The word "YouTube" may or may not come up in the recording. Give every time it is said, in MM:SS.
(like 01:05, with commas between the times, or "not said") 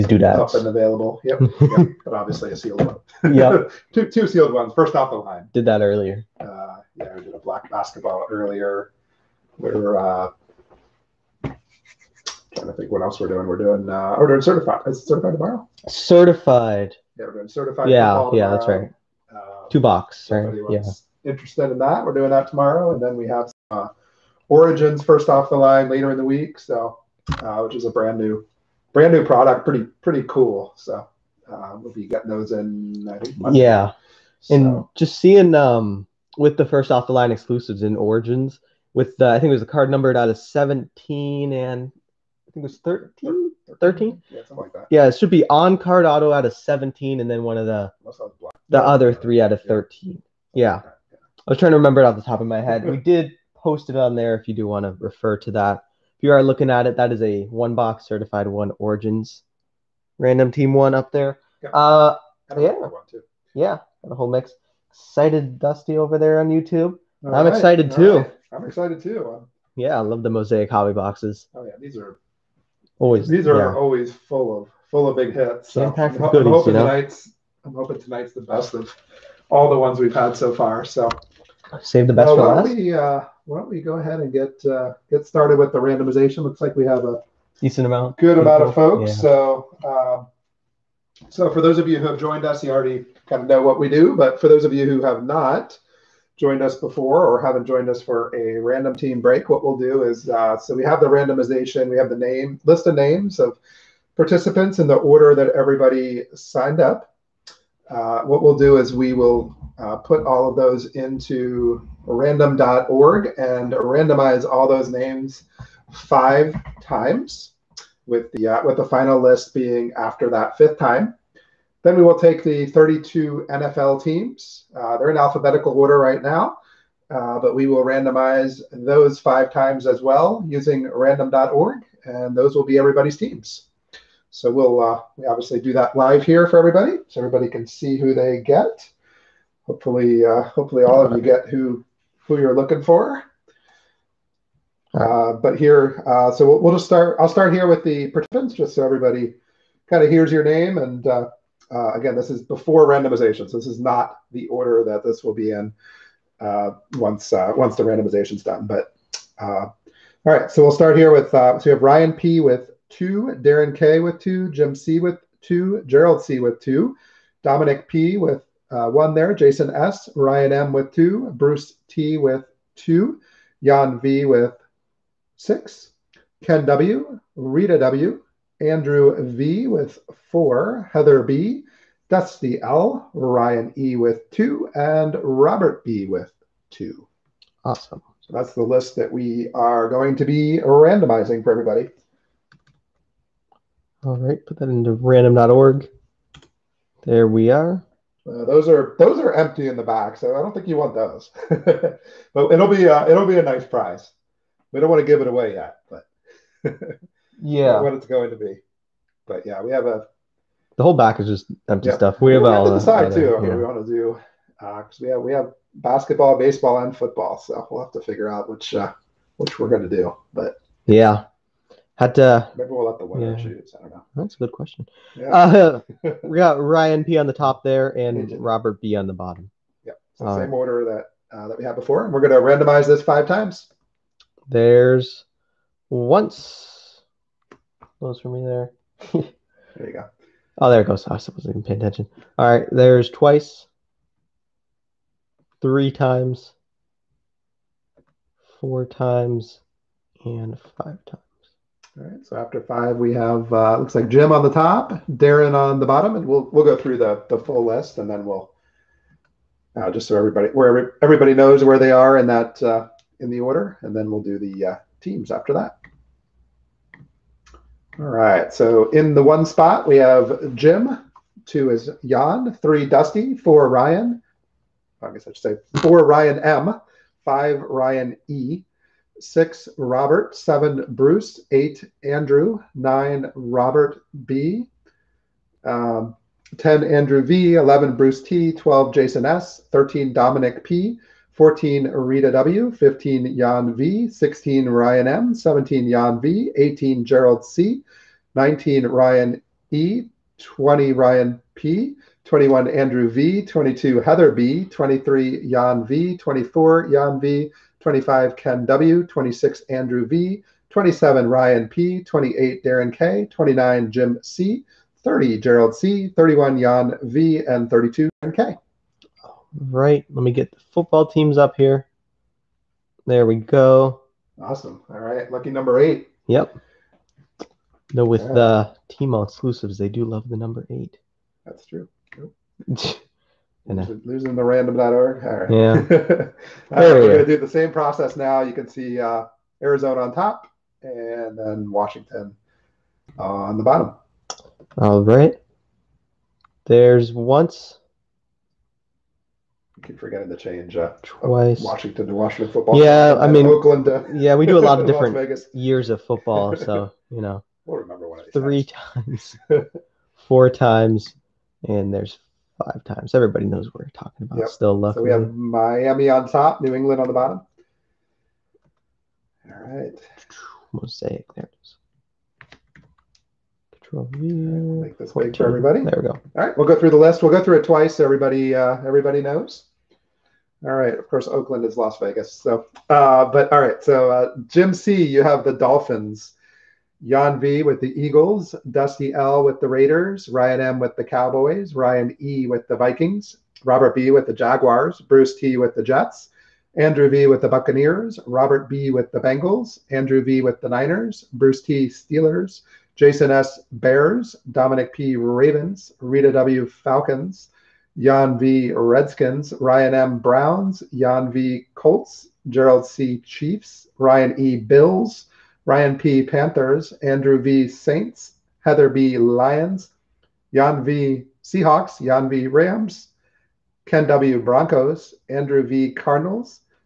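01:06.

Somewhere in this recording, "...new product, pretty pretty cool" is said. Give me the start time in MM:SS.
00:29.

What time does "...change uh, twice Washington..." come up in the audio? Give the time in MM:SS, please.
05:50.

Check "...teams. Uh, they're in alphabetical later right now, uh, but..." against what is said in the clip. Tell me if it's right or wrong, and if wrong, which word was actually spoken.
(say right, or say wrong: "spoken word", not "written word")
wrong: "order", not "later".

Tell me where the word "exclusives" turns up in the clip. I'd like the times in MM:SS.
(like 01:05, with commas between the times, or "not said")
00:37, 05:29.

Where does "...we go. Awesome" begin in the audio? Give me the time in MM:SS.
05:23.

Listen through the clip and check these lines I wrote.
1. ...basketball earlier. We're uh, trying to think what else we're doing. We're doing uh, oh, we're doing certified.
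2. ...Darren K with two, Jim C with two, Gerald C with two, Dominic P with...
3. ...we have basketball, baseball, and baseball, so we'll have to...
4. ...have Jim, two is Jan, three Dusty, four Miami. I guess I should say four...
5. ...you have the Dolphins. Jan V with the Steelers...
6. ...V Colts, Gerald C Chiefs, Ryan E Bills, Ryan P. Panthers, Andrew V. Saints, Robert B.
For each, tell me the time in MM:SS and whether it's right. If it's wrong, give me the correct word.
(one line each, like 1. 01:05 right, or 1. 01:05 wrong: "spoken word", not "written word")
1. 00:07 right
2. 02:43 right
3. 03:35 wrong: "football", not "baseball"
4. 04:29 wrong: "Ryan", not "Miami"
5. 06:25 wrong: "Eagles", not "Steelers"
6. 06:51 wrong: "Heather", not "Robert".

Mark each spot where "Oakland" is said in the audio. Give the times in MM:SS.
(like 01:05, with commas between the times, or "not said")
05:53, 06:21.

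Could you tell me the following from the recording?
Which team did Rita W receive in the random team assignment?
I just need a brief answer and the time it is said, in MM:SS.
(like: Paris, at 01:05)
Falcons, at 06:46.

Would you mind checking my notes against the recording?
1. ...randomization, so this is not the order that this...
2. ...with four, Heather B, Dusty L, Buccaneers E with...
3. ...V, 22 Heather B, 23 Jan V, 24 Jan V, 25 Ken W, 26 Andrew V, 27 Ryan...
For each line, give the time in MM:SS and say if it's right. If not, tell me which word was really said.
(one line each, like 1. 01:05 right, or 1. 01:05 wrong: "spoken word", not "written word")
1. 02:32 right
2. 02:59 wrong: "Ryan", not "Buccaneers"
3. 05:03 right.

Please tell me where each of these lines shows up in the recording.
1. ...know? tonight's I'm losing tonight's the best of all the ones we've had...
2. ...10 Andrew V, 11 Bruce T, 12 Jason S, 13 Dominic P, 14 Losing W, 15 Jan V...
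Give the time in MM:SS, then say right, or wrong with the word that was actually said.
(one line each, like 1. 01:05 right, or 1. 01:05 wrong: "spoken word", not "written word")
1. 01:16 wrong: "hoping", not "losing"
2. 04:46 wrong: "Rita", not "Losing".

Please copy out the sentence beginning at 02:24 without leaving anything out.
Uh, but here, uh, so we'll, we'll, just start.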